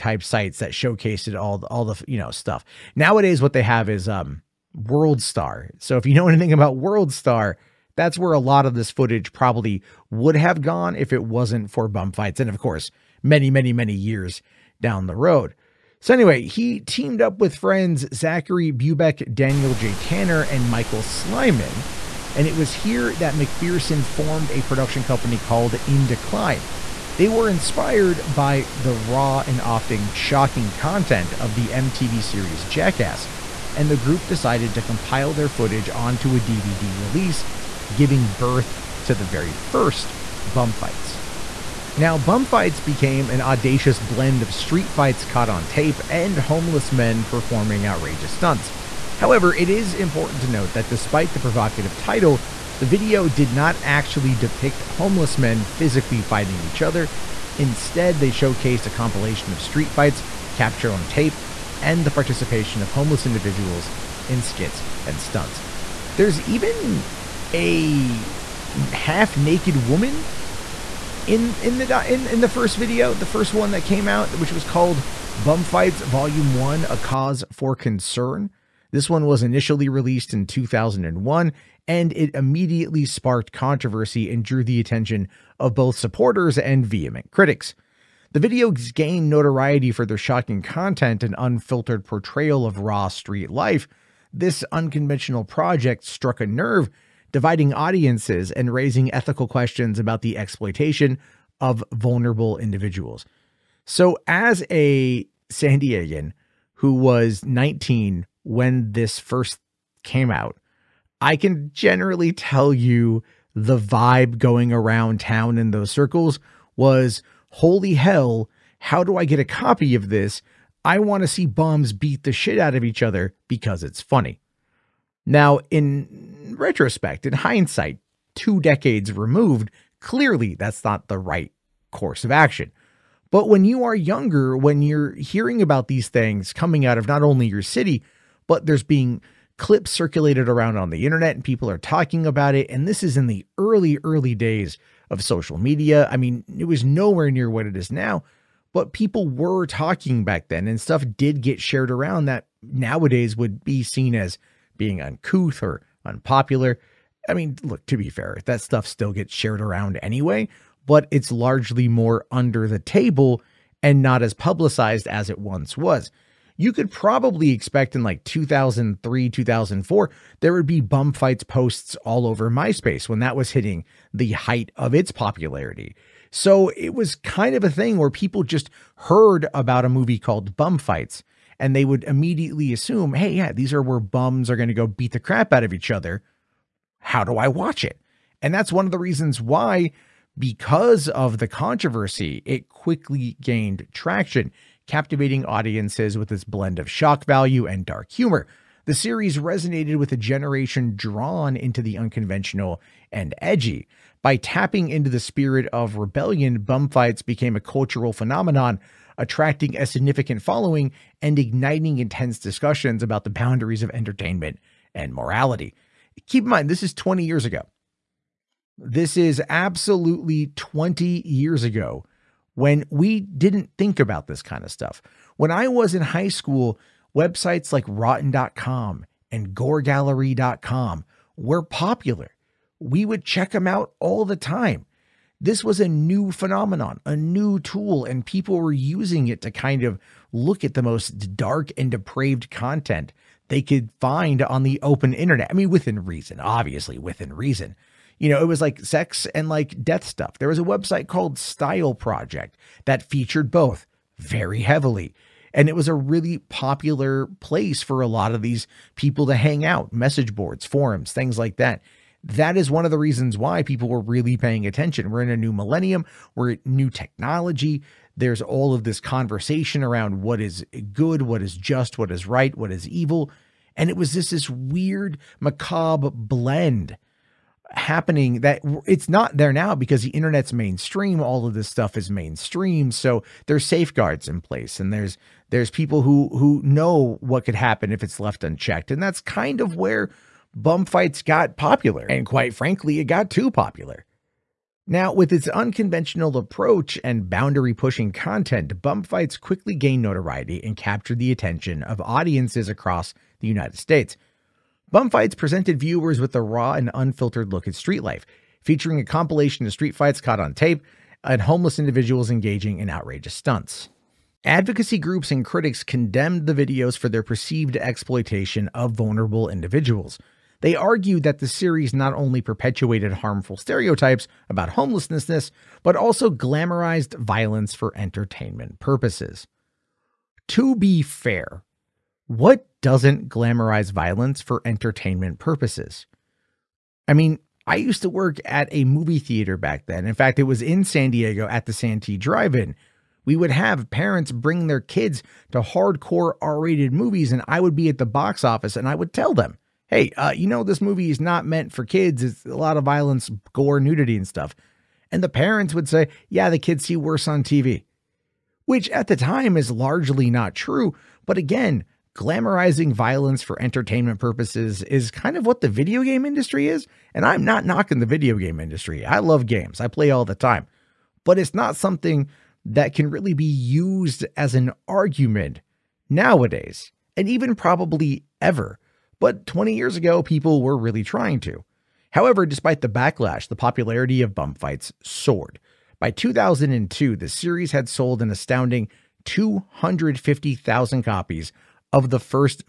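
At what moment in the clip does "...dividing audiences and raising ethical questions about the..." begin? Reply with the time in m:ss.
1:37.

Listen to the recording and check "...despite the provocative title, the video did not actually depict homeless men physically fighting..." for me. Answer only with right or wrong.
right.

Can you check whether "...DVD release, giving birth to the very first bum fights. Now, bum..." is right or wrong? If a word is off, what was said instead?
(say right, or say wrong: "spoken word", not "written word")
right.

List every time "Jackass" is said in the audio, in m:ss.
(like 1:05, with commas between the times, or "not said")
0:32.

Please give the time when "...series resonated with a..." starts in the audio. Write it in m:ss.
3:18.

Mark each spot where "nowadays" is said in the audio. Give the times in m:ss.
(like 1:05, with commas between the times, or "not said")
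0:02, 2:32, 6:16.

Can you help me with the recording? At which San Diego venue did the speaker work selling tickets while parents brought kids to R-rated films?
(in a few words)
Santee Drive In.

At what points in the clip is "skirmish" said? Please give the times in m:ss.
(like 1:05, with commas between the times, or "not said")
not said.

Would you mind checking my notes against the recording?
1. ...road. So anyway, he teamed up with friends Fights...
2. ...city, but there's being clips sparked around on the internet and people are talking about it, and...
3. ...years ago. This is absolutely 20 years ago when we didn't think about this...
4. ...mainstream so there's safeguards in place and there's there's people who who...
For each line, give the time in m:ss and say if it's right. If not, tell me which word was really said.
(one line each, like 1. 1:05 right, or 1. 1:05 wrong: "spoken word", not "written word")
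1. 0:15 wrong: "Zachary", not "Fights"
2. 2:17 wrong: "circulated", not "sparked"
3. 3:37 right
4. 4:42 right.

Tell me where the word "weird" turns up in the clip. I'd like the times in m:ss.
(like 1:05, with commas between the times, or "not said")
4:34.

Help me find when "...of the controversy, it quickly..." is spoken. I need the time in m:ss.
3:11.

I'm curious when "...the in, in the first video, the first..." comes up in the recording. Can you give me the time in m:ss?
1:11.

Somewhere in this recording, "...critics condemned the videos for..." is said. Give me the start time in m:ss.
5:15.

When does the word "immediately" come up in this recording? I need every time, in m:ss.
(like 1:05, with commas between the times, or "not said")
1:22, 3:02.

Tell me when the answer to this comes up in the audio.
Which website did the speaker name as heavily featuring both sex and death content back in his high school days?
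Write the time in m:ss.
4:11.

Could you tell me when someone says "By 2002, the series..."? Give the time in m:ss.
6:25.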